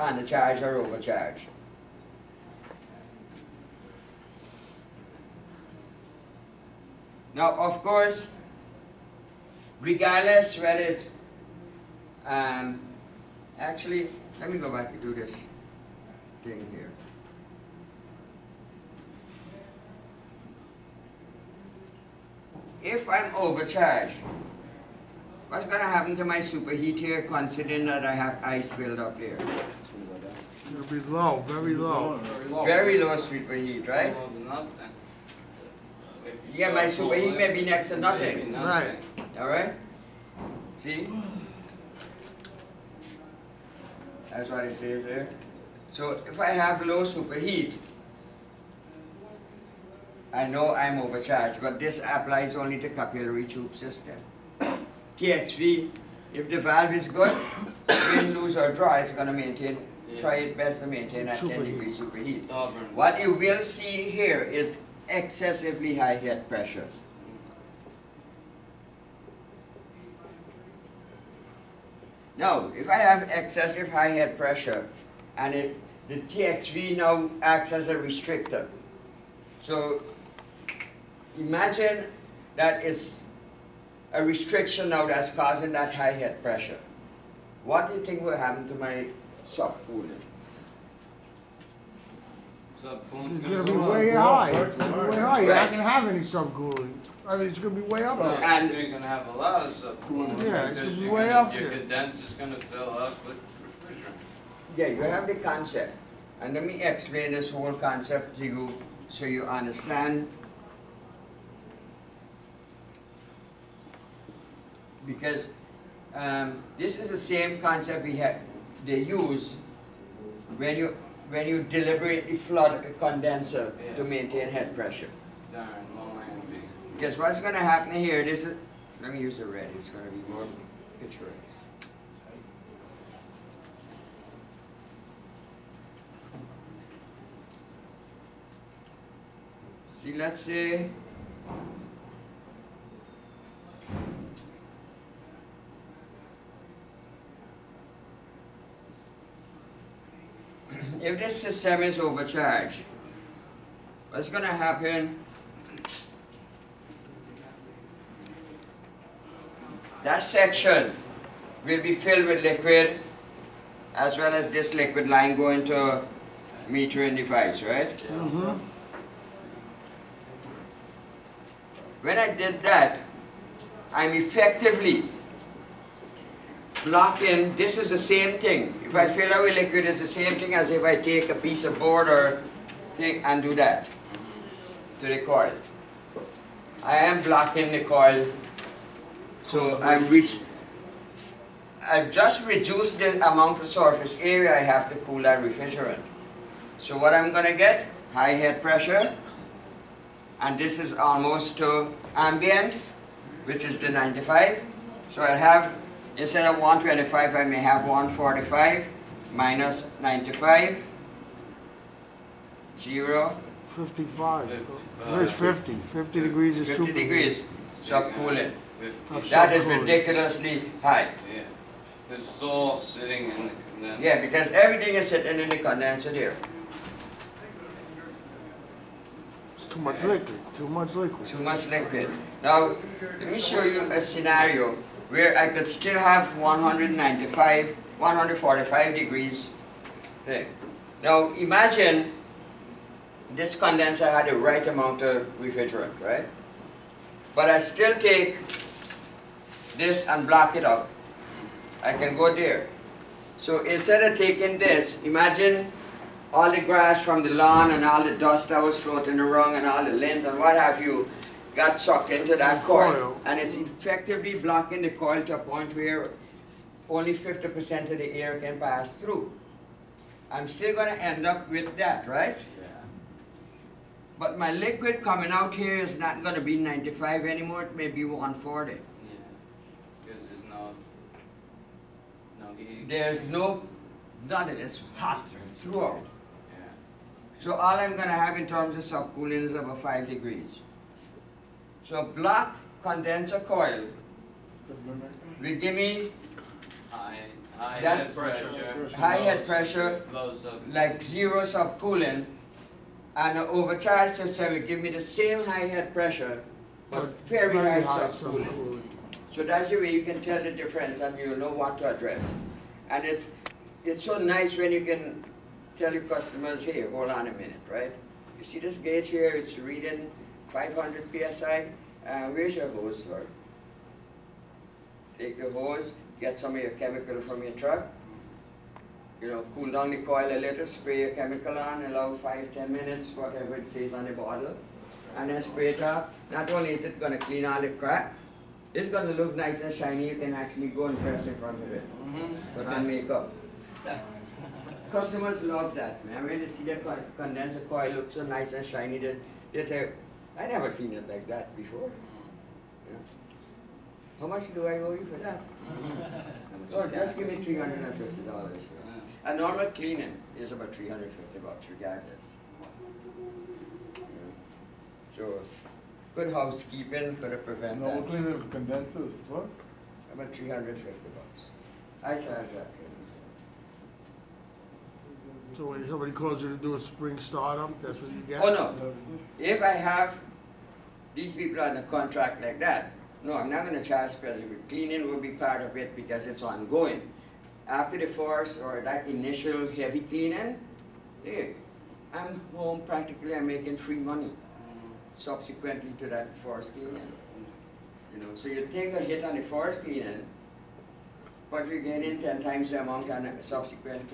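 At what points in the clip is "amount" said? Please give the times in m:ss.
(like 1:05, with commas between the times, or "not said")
3:13, 4:04, 6:42.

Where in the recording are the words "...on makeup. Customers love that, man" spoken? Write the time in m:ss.
5:42.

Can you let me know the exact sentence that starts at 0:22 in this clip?
If I'm overcharged, what's going to happen to my superheat here considering that I have ice build up here?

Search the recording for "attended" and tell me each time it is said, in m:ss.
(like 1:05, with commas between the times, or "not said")
not said.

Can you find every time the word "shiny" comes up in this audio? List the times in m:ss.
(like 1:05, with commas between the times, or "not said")
5:39, 5:48.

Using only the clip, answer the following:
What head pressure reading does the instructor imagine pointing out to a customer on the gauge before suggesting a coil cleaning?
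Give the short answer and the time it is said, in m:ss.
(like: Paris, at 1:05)
500 psi, at 5:20.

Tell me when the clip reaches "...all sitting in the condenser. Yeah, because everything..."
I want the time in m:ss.
3:42.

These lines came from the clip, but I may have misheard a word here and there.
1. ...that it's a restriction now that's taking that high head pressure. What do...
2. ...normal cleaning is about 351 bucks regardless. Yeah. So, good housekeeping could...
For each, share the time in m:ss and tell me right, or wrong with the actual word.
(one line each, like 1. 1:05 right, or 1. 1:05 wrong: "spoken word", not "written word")
1. 1:22 wrong: "causing", not "taking"
2. 5:59 wrong: "350", not "351".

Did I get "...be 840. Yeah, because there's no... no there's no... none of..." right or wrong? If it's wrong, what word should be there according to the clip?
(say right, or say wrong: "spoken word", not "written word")
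wrong: "140", not "840".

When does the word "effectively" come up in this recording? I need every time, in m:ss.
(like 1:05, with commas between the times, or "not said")
2:54, 4:23.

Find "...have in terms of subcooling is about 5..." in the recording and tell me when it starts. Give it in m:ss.
4:48.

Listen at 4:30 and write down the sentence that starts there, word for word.
I'm still going to end up with that, right?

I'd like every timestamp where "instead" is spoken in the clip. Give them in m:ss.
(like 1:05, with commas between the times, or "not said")
3:26, 4:13.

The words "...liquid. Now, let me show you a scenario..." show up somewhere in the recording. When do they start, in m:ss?
3:51.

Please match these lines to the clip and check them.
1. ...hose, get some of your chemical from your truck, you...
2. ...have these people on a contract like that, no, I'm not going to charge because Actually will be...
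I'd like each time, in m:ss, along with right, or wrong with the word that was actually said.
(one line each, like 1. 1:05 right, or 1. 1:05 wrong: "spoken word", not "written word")
1. 5:25 right
2. 6:19 wrong: "Cleaning", not "Actually".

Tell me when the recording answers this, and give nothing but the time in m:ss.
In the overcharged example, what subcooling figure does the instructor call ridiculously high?
3:35.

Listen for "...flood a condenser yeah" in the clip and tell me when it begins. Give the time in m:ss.
2:02.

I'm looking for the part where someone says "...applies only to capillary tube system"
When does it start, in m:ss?
0:51.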